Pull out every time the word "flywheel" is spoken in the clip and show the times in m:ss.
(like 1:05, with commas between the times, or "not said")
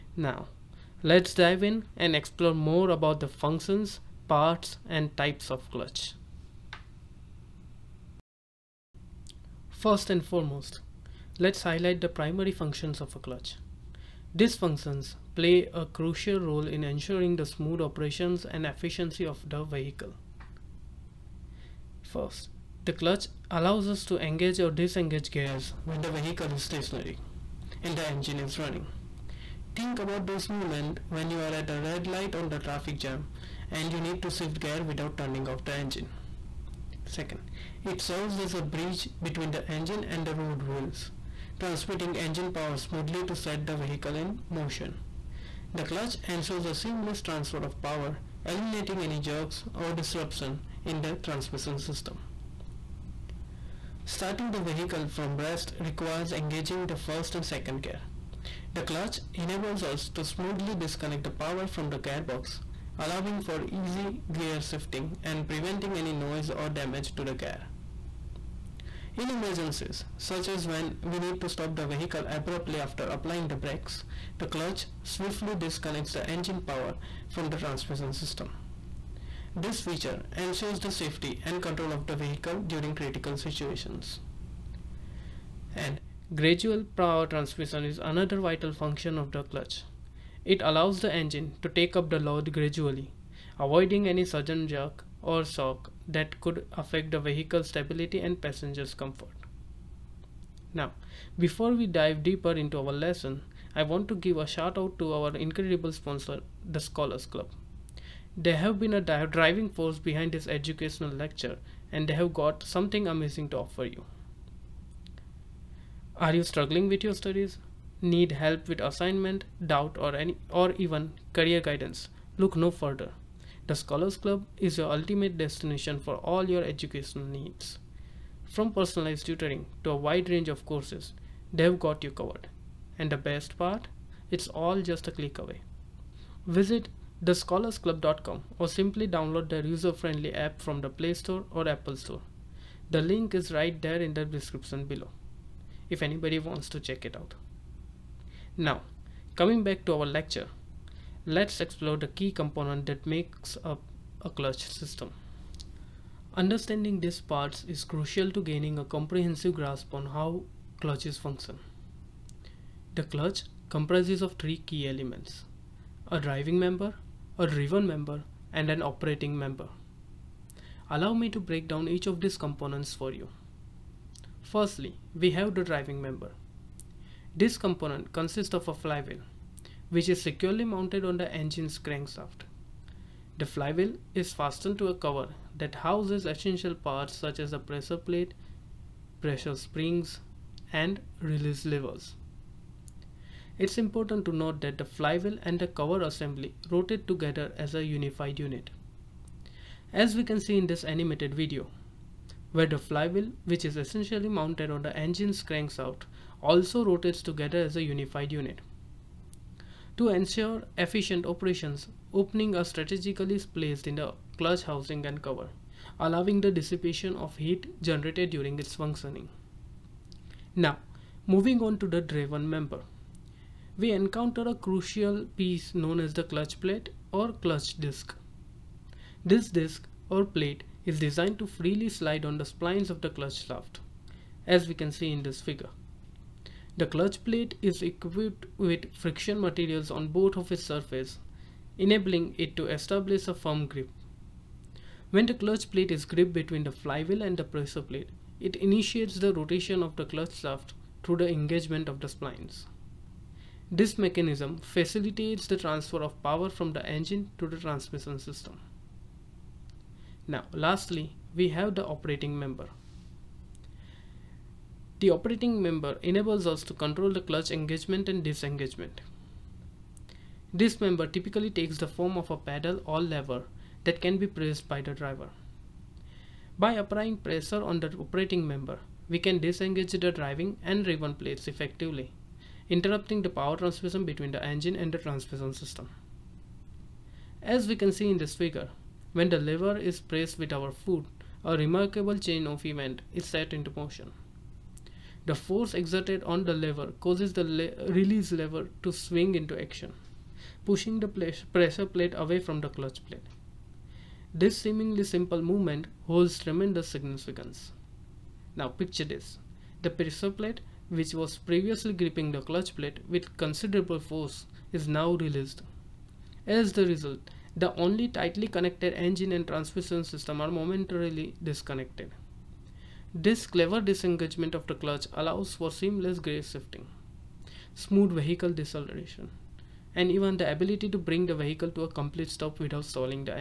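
2:58, 3:03, 3:14, 3:22, 4:06.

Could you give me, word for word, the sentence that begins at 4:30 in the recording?
This member typically takes the form of a pedal or lever that can be pressed by the driver.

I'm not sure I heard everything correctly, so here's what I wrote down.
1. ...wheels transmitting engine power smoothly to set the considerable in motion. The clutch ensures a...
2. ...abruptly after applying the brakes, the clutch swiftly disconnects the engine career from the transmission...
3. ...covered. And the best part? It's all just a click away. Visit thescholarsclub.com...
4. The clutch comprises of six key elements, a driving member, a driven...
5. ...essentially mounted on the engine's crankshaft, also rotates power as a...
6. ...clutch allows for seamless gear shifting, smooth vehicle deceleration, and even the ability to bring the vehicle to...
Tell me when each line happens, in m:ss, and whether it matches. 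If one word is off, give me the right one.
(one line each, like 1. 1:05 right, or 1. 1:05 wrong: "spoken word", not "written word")
1. 0:40 wrong: "vehicle", not "considerable"
2. 1:12 wrong: "power", not "career"
3. 2:12 right
4. 2:42 wrong: "three", not "six"
5. 3:23 wrong: "together", not "power"
6. 5:24 right.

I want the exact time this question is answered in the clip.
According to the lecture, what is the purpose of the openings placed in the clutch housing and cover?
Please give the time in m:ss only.
3:36.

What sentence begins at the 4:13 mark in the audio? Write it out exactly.
This mechanism facilitates the transfer of power from the engine to the transmission system.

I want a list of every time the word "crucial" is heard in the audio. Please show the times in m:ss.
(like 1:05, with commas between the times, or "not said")
0:15, 2:37, 3:44.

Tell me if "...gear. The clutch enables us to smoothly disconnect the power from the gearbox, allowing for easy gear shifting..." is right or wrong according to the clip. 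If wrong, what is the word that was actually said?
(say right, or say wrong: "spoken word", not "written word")
right.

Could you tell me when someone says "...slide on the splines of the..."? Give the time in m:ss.
3:51.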